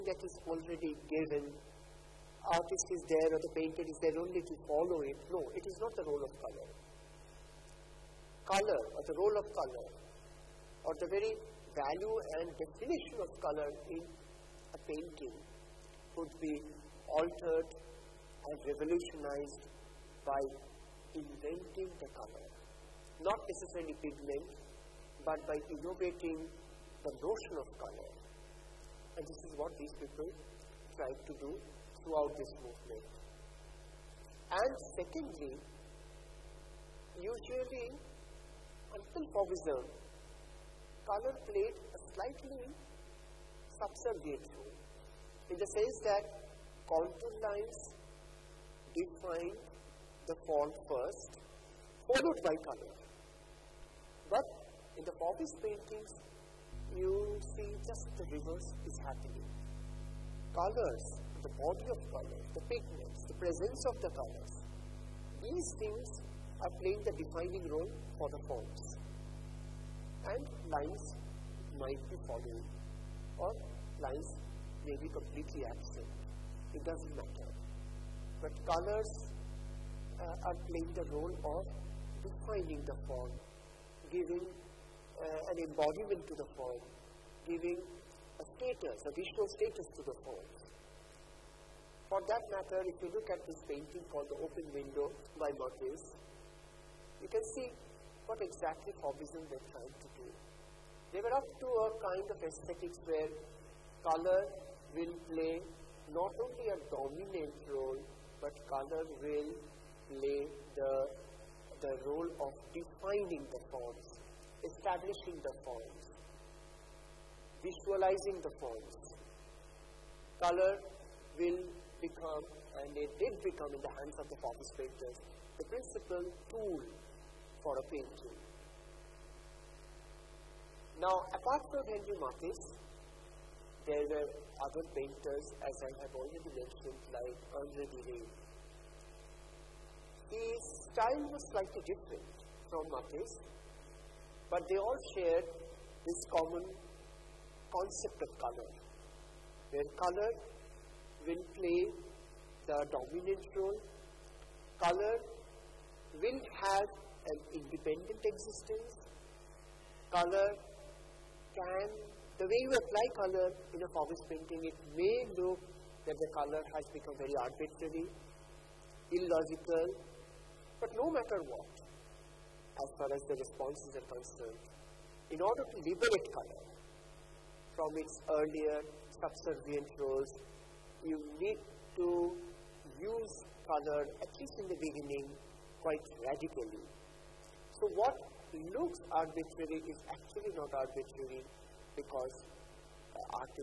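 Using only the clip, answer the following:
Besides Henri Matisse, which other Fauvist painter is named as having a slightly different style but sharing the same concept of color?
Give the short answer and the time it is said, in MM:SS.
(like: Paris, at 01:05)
Andre Derain, at 02:17.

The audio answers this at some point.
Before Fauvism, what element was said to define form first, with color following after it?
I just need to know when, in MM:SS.
00:46.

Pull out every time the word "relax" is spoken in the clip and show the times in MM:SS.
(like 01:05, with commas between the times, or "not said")
not said.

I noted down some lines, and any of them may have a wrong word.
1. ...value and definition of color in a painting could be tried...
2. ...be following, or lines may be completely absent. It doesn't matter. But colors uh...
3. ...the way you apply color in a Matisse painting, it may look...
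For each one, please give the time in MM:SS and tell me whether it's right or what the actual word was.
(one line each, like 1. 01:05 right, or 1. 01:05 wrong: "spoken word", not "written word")
1. 00:11 wrong: "altered", not "tried"
2. 01:12 right
3. 02:42 wrong: "Fauvist", not "Matisse".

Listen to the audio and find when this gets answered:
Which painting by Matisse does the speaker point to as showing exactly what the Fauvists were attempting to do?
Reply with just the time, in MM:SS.
01:34.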